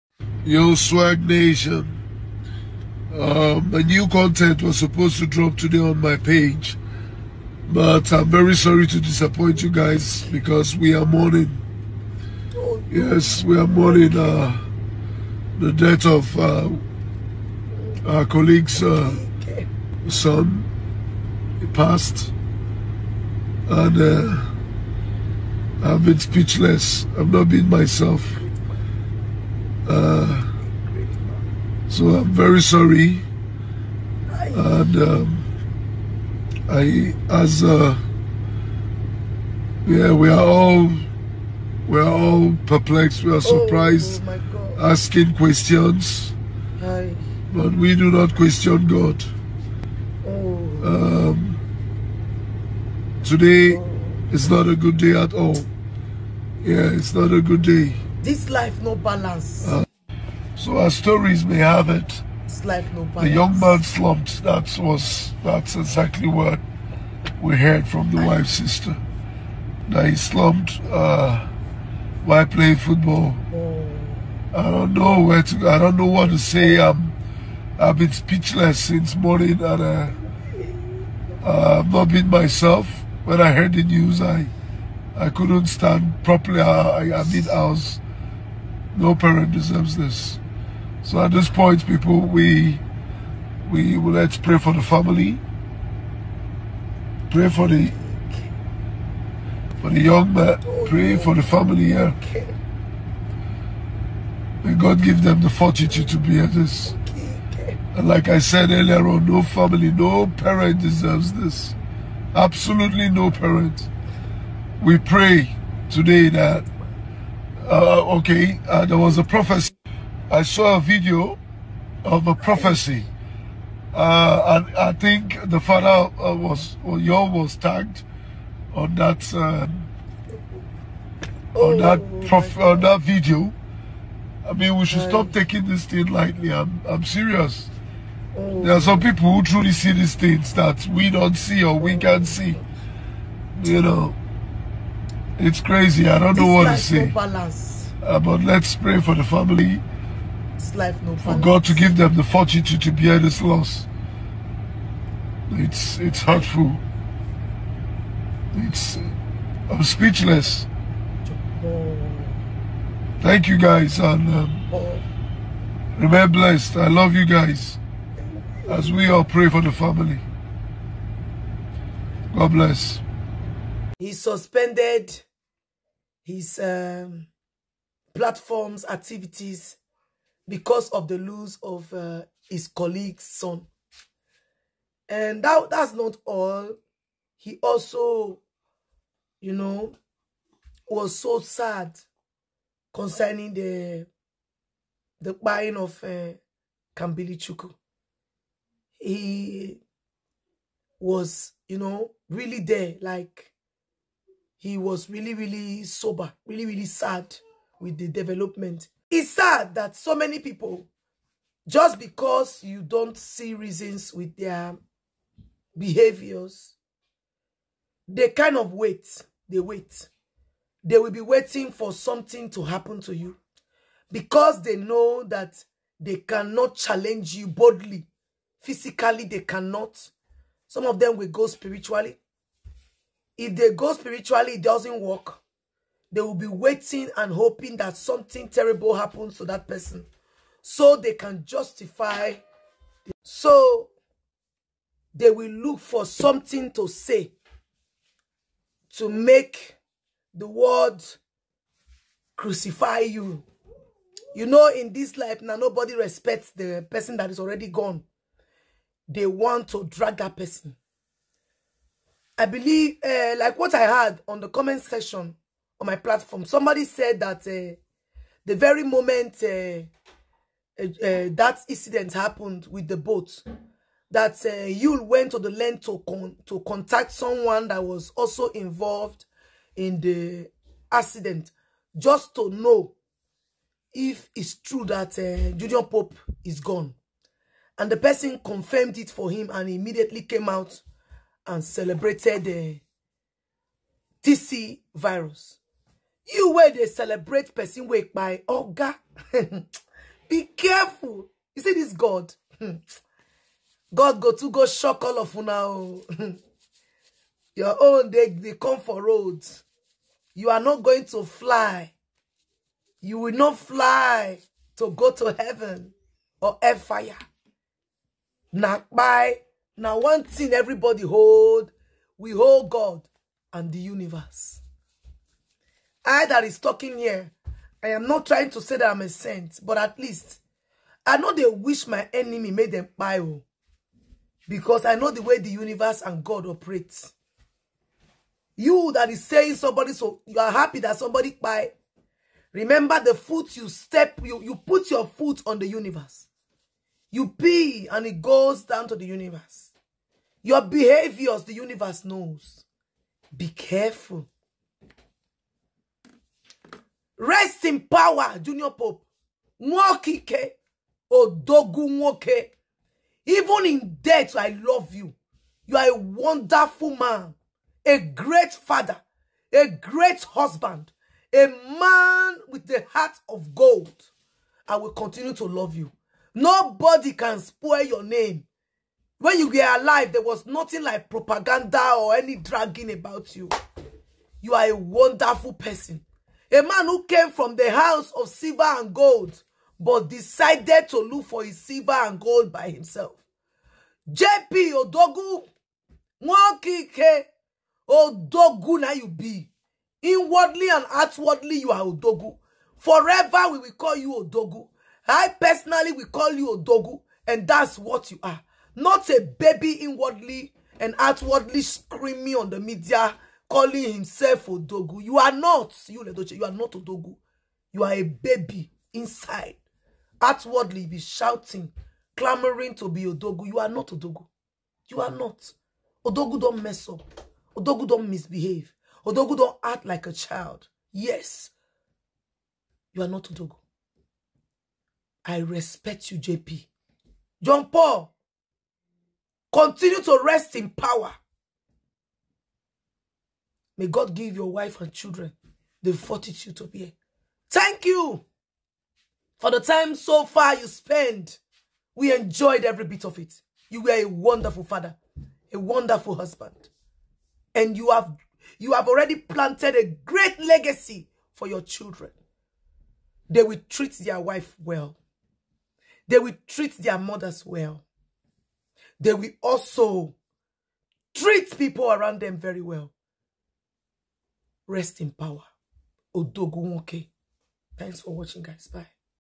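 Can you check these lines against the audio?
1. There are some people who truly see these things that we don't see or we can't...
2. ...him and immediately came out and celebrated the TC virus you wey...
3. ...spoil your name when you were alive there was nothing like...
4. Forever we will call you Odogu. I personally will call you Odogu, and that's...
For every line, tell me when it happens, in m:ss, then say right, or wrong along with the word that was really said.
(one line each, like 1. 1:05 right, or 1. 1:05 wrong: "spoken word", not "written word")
1. 2:18 right
2. 4:49 right
3. 6:17 right
4. 6:42 right.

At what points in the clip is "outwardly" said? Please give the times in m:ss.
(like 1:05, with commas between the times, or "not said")
6:40, 6:50, 7:00.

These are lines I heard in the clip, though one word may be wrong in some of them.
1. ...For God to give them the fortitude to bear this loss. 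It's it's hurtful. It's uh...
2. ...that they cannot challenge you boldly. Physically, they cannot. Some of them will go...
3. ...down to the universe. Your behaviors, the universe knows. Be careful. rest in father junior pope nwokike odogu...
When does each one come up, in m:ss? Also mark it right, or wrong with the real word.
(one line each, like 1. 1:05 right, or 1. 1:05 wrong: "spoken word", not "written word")
1. 2:31 right
2. 3:45 right
3. 5:48 wrong: "power", not "father".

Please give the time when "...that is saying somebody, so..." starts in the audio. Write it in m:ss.
5:38.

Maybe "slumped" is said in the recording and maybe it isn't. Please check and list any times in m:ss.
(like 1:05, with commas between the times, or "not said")
1:03, 1:10.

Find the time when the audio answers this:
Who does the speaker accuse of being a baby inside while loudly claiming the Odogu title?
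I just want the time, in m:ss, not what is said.
6:56.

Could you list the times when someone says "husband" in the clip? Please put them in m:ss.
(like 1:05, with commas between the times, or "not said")
6:10, 7:36.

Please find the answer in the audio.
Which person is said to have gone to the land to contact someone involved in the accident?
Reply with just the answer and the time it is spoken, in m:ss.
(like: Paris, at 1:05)
Yul, at 4:34.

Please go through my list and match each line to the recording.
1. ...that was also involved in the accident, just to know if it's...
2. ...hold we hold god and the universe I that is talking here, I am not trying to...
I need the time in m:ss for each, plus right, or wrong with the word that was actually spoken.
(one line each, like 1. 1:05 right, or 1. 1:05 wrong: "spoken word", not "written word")
1. 4:37 right
2. 5:21 right.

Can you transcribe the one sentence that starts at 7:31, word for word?
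We enjoyed every bit of it.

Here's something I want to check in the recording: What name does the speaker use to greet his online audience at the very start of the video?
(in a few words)
Swag Nation.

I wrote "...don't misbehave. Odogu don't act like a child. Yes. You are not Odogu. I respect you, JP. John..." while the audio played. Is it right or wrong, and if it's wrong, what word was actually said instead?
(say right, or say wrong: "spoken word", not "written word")
right.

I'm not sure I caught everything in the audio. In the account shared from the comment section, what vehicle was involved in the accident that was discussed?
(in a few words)
Boat.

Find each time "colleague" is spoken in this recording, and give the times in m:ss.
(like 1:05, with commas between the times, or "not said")
0:18, 3:02.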